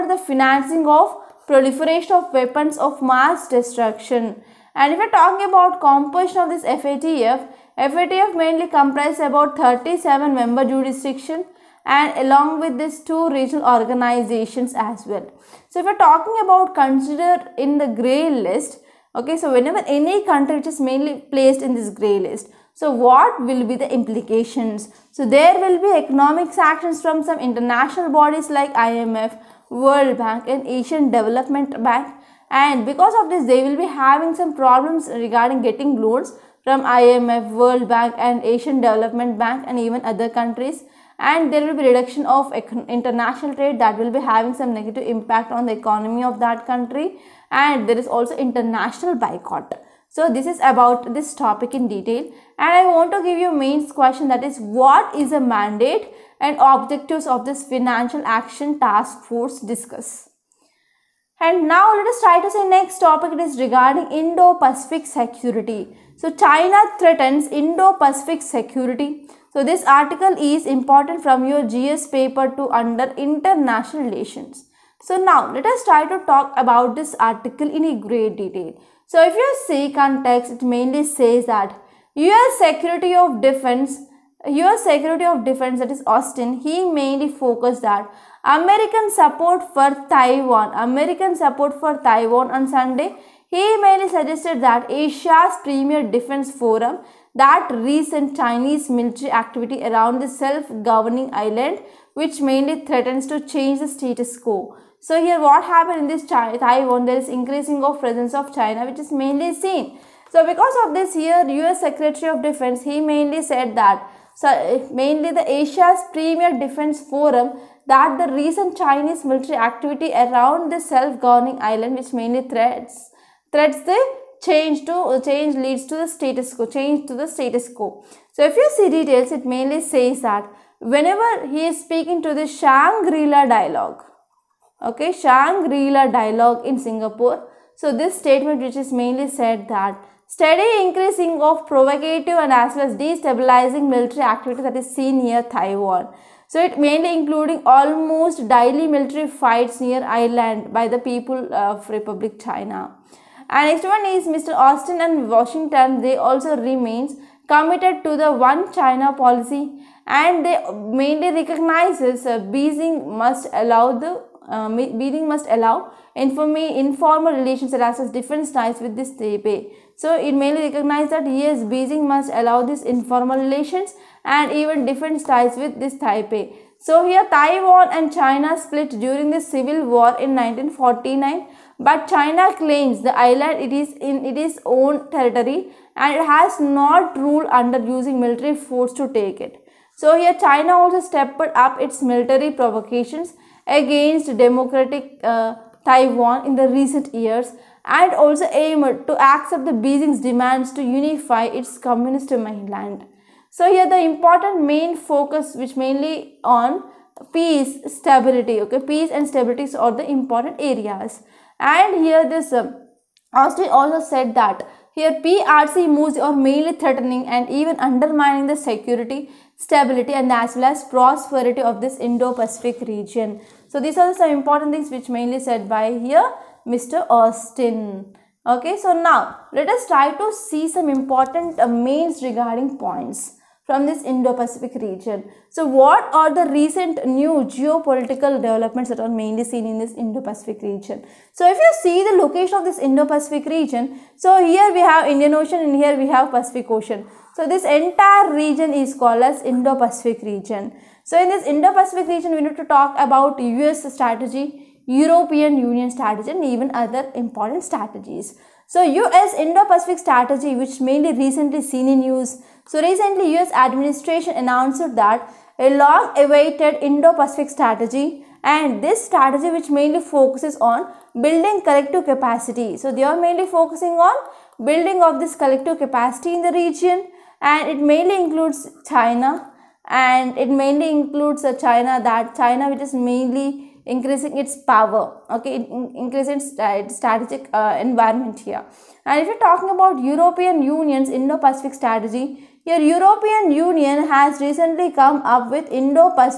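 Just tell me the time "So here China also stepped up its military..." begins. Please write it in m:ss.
3:09.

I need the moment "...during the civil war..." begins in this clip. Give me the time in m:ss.
2:58.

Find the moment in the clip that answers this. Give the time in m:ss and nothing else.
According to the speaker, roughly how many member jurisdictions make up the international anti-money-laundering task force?
0:09.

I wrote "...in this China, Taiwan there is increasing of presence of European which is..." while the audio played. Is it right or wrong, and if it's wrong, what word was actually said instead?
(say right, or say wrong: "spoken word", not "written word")
wrong: "China", not "European".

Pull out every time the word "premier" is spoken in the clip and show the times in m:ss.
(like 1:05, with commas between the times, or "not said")
1:35, 1:56.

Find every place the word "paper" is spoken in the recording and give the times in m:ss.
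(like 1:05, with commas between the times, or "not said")
1:12.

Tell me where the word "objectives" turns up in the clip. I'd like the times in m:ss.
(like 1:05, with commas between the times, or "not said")
0:56.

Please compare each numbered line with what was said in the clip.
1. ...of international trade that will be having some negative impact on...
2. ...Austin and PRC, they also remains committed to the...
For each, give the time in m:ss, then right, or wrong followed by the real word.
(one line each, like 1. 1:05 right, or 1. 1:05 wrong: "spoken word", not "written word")
1. 0:42 right
2. 2:34 wrong: "Washington", not "PRC".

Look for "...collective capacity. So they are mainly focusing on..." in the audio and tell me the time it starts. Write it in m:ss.
4:31.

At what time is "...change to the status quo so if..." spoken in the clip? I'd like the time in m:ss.
2:06.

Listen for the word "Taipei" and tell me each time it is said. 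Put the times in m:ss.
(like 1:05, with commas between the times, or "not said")
2:49, 2:56.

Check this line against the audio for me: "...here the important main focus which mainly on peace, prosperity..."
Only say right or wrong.
wrong.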